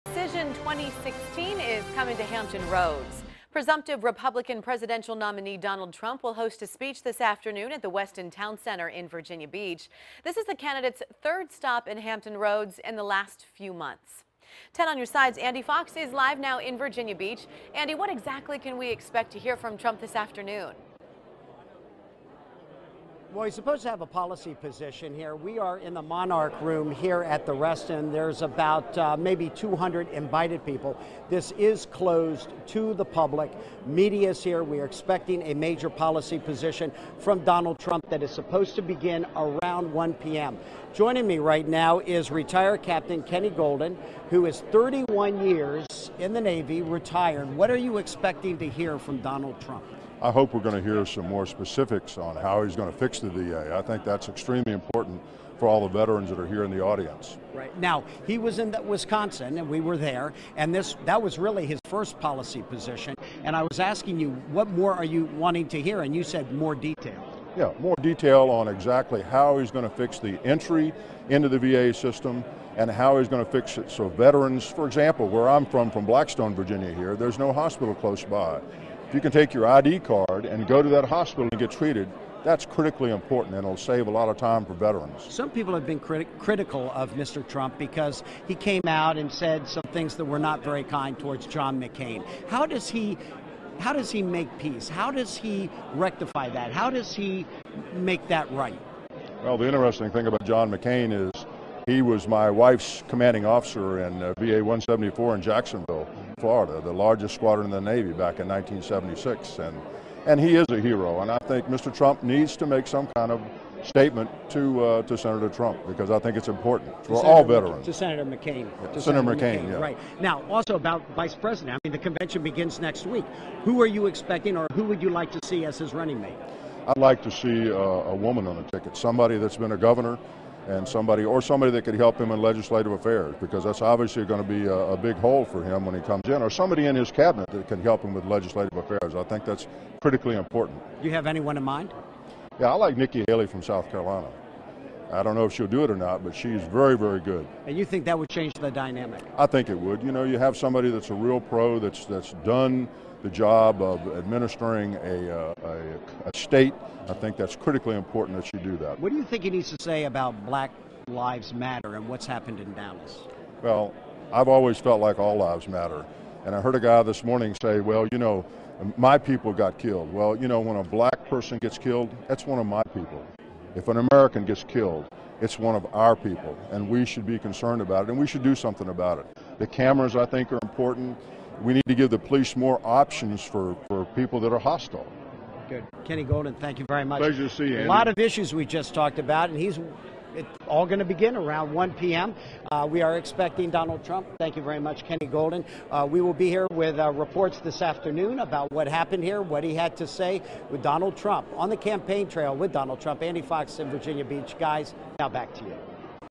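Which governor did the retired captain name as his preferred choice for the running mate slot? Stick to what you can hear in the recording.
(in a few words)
Nikki Haley.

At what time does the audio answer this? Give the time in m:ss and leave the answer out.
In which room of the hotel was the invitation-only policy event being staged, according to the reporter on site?
0:26.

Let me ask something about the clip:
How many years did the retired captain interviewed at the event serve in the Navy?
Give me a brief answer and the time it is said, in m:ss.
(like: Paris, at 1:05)
31, at 0:44.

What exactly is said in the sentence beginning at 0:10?
This is the candidate's third stop in Hampton Roads in the last few months.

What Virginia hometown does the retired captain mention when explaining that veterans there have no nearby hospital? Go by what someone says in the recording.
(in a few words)
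Blackstone, Virginia.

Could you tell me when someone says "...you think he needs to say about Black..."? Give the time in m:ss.
2:39.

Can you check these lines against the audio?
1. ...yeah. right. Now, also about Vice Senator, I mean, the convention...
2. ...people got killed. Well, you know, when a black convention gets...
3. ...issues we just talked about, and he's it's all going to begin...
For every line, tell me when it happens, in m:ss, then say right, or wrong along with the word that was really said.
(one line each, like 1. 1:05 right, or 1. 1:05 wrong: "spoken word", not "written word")
1. 1:59 wrong: "President", not "Senator"
2. 2:49 wrong: "person", not "convention"
3. 3:08 right.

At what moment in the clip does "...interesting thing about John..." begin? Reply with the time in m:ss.
1:39.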